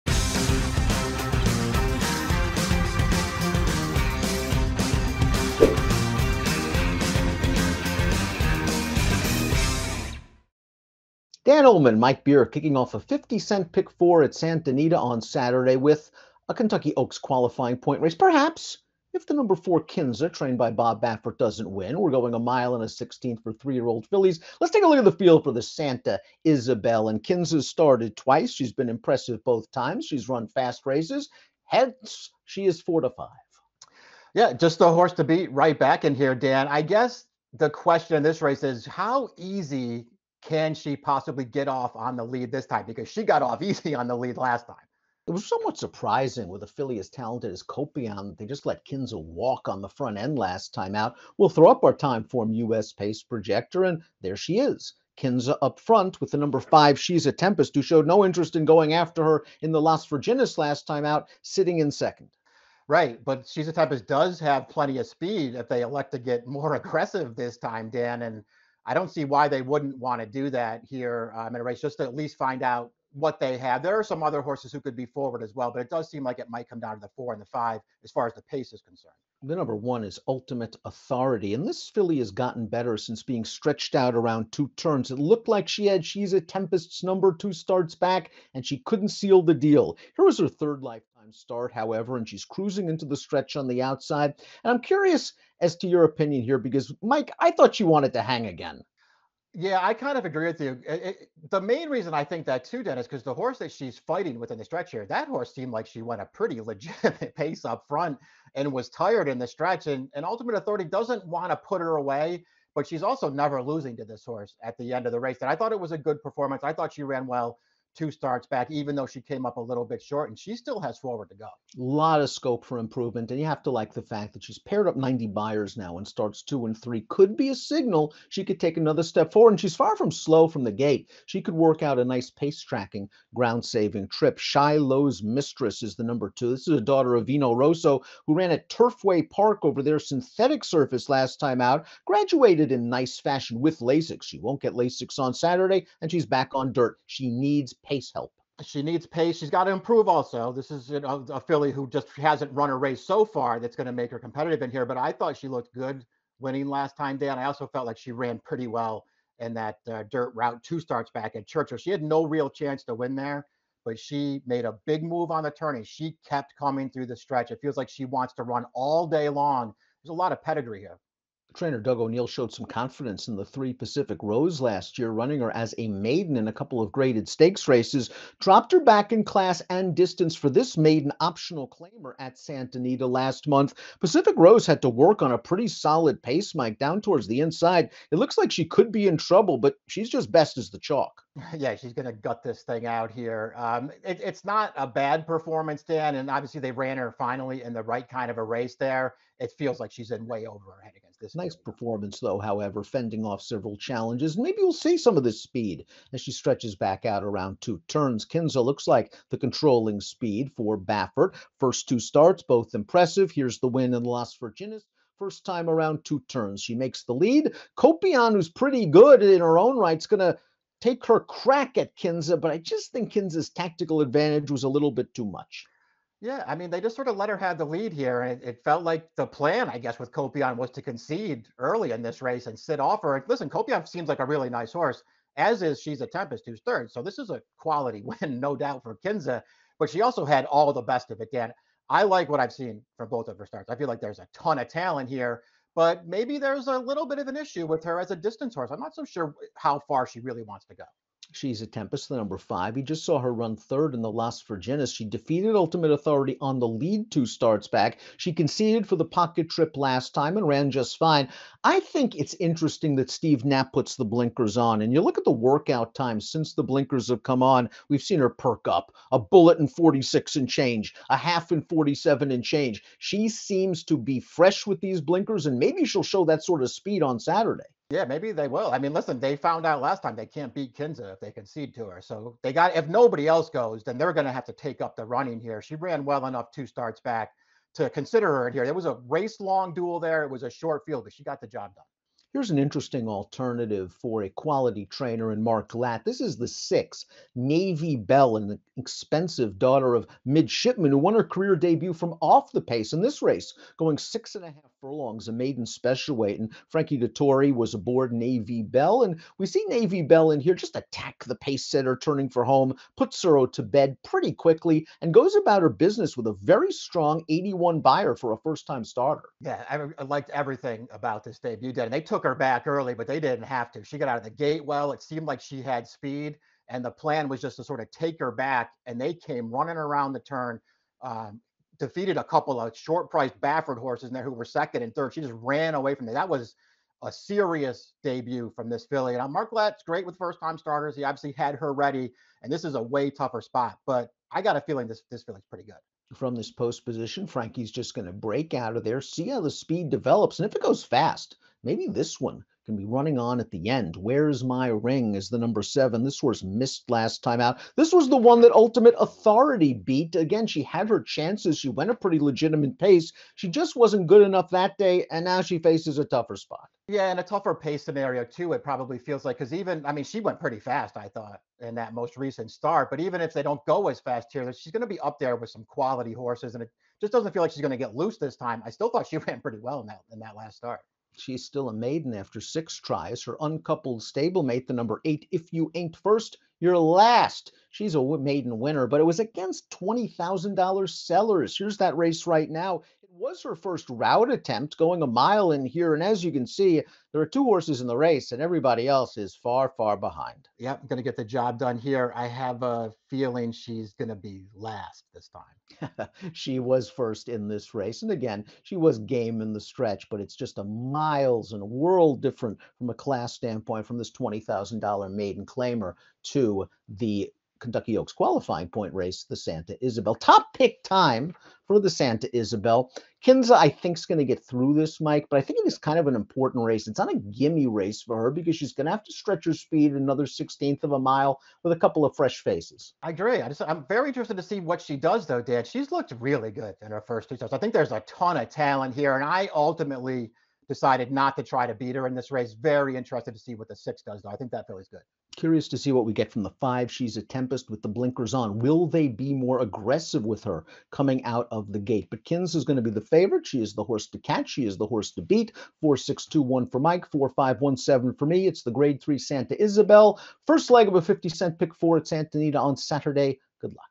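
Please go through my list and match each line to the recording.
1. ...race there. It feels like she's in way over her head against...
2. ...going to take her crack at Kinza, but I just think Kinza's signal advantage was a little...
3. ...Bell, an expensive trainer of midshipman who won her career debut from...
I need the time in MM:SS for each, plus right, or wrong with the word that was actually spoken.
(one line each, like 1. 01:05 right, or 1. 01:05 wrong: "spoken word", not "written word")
1. 03:18 right
2. 03:40 wrong: "tactical", not "signal"
3. 04:57 wrong: "daughter", not "trainer".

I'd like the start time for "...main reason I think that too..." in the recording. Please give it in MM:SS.
01:41.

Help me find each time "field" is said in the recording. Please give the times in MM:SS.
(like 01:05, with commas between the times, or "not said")
00:25, 04:50.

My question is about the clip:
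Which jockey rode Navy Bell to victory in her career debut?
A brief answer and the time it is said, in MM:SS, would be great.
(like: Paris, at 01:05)
Frankie Dettori, at 05:06.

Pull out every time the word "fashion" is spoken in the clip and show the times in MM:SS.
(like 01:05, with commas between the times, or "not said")
02:23.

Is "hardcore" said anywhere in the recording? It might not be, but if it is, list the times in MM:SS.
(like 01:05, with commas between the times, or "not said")
not said.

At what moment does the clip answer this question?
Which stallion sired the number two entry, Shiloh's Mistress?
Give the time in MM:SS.
02:17.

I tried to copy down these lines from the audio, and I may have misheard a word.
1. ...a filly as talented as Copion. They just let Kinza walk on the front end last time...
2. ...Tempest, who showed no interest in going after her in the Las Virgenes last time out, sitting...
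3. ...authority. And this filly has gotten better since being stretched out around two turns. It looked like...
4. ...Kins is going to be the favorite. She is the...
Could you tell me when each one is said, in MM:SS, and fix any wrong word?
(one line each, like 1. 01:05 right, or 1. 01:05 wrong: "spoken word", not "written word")
1. 00:46 right
2. 00:57 right
3. 01:20 right
4. 07:32 right.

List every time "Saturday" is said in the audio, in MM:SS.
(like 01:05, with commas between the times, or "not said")
00:15, 02:25, 04:37, 07:42.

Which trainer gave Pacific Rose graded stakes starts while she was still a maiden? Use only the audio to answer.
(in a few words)
Doug O'Neill.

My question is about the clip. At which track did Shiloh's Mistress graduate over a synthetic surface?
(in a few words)
Turfway Park.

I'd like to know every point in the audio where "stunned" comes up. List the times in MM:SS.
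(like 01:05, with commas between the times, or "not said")
not said.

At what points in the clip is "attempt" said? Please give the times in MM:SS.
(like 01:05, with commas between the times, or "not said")
06:34.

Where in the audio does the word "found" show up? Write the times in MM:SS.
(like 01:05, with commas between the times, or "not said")
04:39.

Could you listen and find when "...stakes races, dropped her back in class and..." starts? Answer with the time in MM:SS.
02:57.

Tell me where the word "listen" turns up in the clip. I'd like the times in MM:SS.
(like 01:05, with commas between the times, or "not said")
03:53, 04:38.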